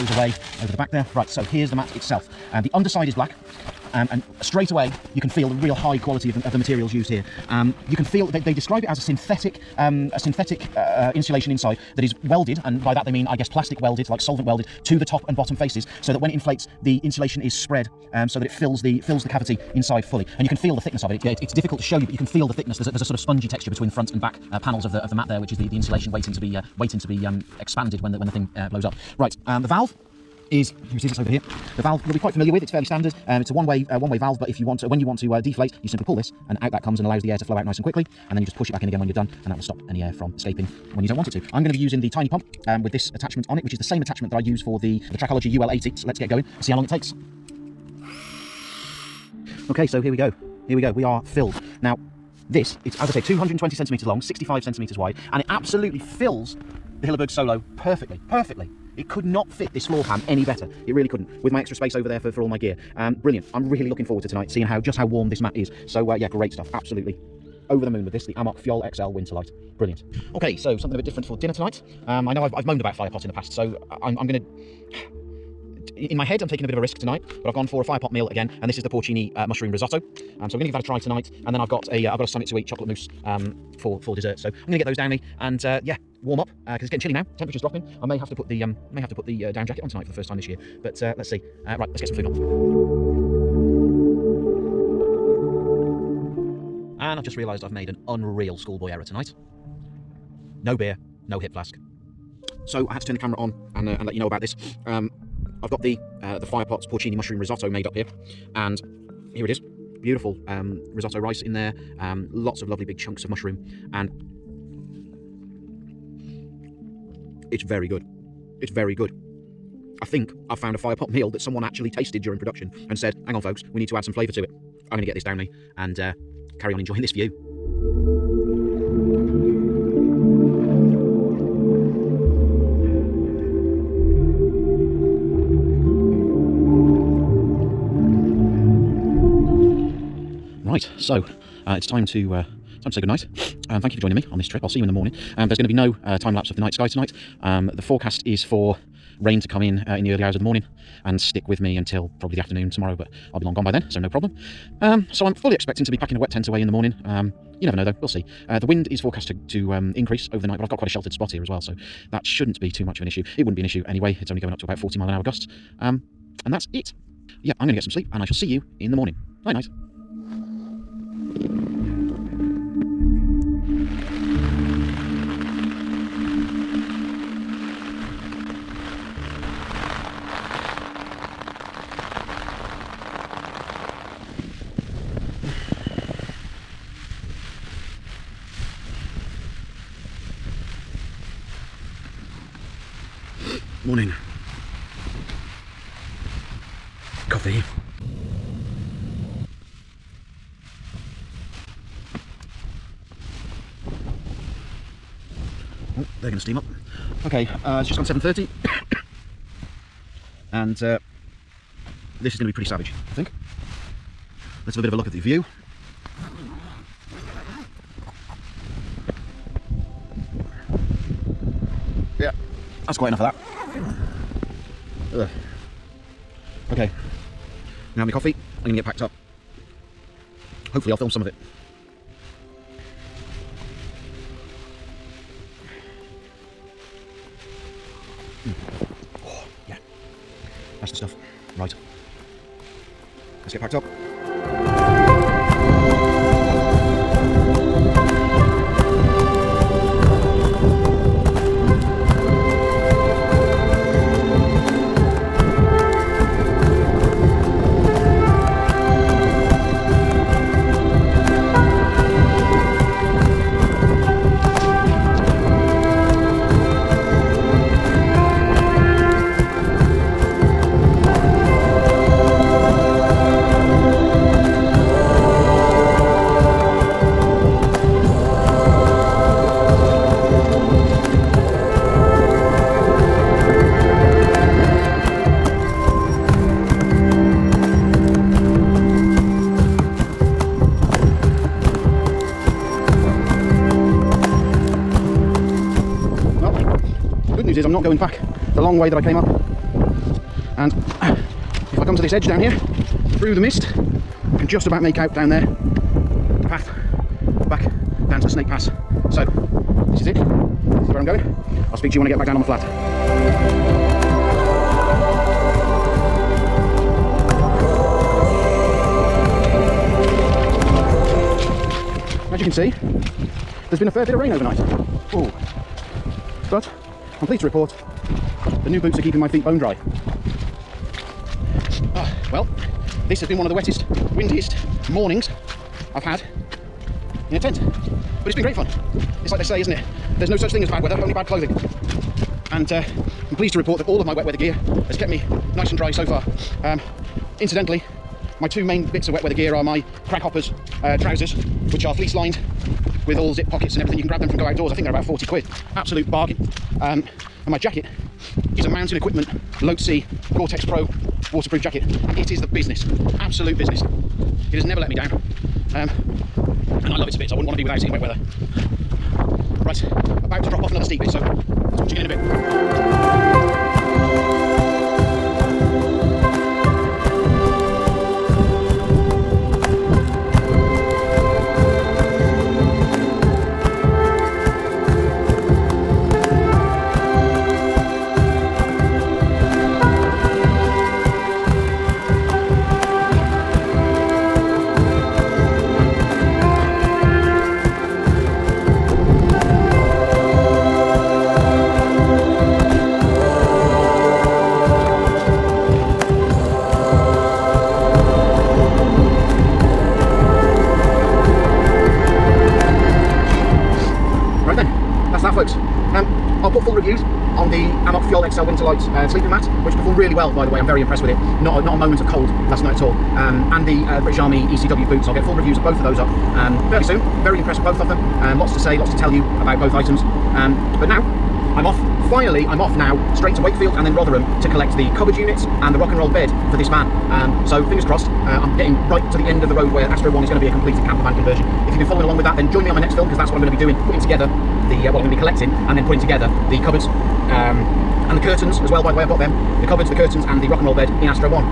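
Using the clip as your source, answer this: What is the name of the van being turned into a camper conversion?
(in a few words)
Astro One.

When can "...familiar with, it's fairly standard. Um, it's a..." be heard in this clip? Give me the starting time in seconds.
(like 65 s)
32 s.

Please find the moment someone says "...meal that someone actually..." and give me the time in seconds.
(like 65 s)
121 s.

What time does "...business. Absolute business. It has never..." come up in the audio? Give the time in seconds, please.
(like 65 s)
362 s.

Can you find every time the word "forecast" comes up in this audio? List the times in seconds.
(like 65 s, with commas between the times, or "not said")
147 s, 158 s.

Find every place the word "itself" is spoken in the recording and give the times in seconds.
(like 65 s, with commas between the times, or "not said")
1 s.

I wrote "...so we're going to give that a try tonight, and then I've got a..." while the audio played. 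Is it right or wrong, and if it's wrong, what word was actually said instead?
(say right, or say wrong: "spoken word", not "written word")
right.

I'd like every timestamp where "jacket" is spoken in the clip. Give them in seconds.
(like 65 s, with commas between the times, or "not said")
89 s, 357 s, 361 s.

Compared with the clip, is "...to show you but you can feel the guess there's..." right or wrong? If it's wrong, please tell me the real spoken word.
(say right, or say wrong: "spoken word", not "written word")
wrong: "thickness", not "guess".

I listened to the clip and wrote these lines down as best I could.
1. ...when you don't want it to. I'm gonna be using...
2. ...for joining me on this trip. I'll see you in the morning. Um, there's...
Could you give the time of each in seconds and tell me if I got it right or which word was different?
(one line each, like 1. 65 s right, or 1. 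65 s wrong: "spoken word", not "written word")
1. 40 s right
2. 143 s right.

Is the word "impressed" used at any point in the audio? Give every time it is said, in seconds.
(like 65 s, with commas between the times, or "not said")
420 s, 427 s.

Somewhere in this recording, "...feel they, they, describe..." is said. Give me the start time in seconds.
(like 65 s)
8 s.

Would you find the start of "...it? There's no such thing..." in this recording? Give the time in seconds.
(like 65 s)
339 s.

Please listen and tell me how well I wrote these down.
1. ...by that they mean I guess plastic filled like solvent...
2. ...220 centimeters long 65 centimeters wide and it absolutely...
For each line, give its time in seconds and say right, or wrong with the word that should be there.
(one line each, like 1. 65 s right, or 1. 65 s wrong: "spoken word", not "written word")
1. 12 s wrong: "welded", not "filled"
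2. 53 s right.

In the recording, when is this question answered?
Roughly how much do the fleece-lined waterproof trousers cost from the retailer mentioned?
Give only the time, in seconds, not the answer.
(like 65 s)
354 s.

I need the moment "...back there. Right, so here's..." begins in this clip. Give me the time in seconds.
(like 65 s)
0 s.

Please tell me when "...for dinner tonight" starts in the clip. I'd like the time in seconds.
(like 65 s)
71 s.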